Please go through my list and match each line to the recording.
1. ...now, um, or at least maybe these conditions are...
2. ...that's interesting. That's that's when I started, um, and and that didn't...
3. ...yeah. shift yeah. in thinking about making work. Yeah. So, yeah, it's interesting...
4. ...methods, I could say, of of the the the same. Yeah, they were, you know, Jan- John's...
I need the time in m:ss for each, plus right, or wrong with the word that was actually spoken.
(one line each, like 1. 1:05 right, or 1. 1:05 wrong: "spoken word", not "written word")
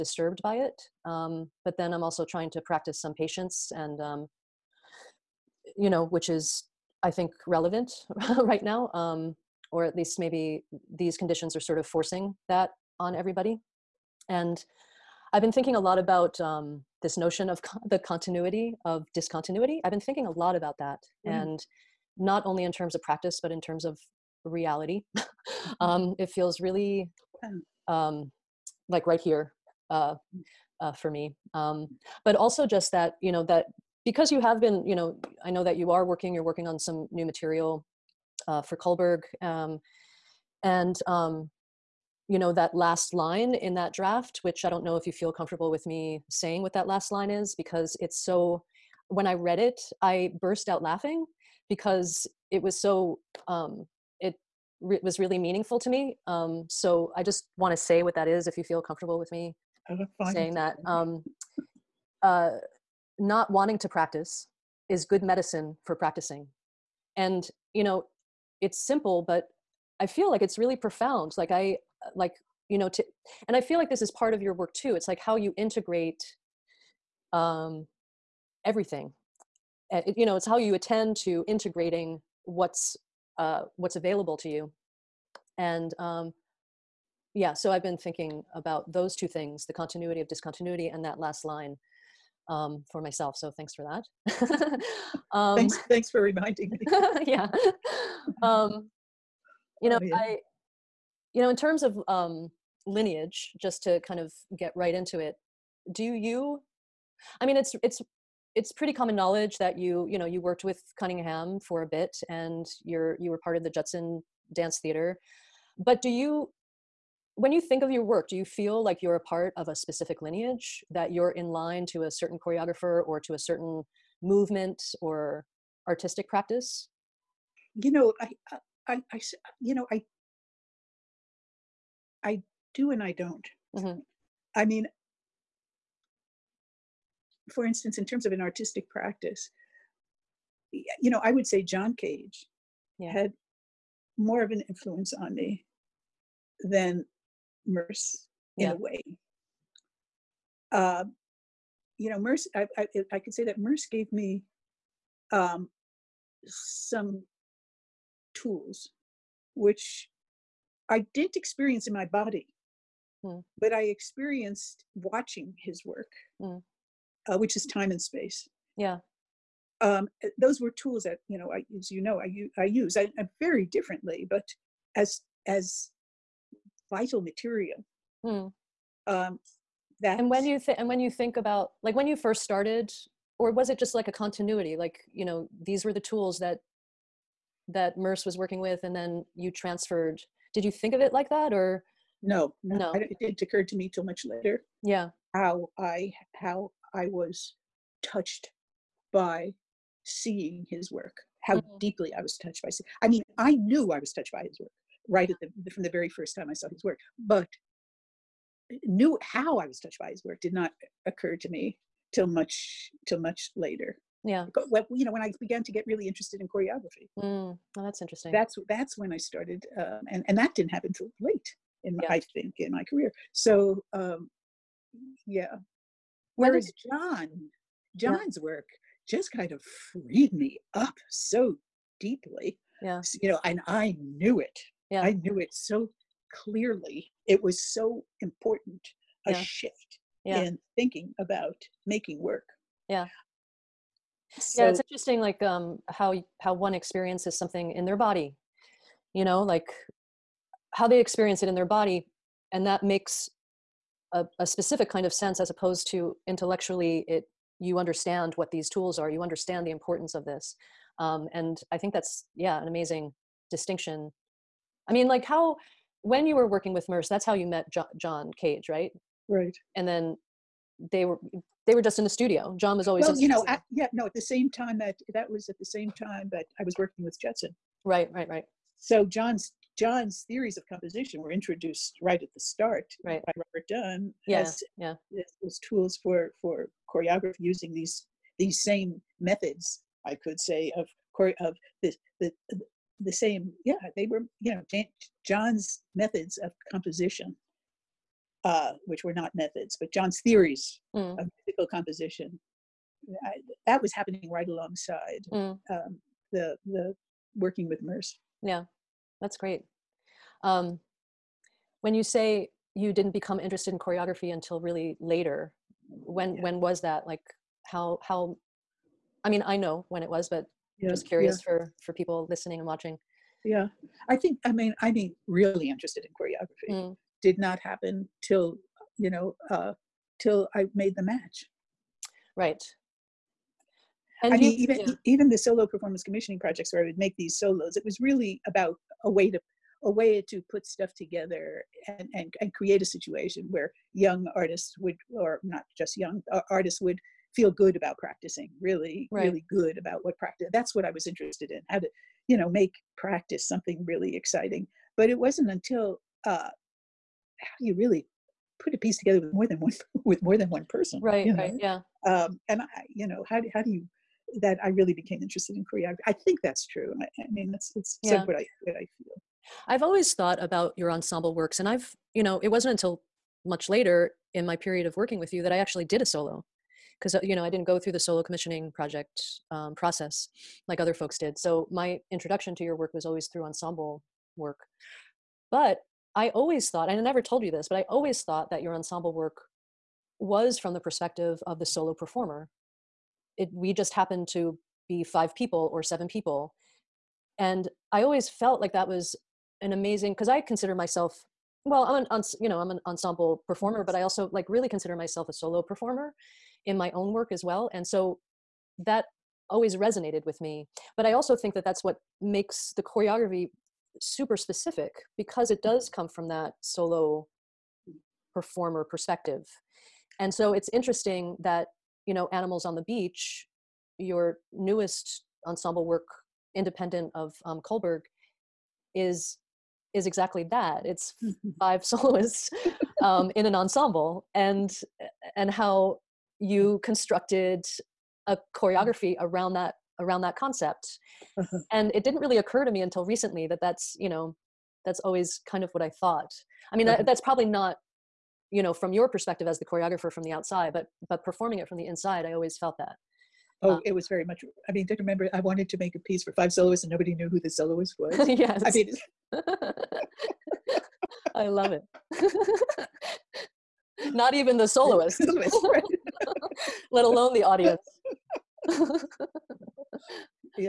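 1. 0:08 right
2. 3:37 right
3. 3:59 right
4. 4:49 right.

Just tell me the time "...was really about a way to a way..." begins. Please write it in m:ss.
5:37.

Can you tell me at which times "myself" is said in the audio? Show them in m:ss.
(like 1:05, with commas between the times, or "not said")
1:32, 6:40, 6:44.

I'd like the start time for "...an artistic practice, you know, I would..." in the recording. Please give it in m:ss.
2:18.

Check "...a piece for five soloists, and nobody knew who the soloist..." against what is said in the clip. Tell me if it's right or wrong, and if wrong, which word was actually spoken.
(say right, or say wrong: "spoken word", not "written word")
right.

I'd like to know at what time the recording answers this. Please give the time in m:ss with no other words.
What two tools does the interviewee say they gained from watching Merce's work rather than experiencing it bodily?
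2:47.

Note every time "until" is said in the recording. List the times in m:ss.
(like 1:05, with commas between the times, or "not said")
5:14, 5:55, 6:12, 7:22.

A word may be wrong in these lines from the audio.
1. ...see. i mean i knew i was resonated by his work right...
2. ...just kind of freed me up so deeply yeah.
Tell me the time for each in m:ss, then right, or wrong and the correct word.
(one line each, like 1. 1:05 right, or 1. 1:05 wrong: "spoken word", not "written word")
1. 3:22 wrong: "touched", not "resonated"
2. 3:49 right.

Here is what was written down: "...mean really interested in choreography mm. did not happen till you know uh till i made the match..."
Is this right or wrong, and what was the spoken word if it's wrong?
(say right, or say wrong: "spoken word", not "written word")
right.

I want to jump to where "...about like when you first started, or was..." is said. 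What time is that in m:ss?
3:01.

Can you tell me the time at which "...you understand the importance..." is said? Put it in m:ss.
4:19.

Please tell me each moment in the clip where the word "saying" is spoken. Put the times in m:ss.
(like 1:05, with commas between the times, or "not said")
0:46, 1:00.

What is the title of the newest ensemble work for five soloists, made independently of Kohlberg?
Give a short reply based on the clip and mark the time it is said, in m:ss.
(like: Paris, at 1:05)
Animals on the Beach, at 7:02.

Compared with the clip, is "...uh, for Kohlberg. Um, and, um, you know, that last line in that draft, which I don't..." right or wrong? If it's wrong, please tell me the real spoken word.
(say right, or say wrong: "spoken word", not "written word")
right.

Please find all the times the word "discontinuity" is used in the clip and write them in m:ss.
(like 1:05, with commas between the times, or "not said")
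0:19, 1:30.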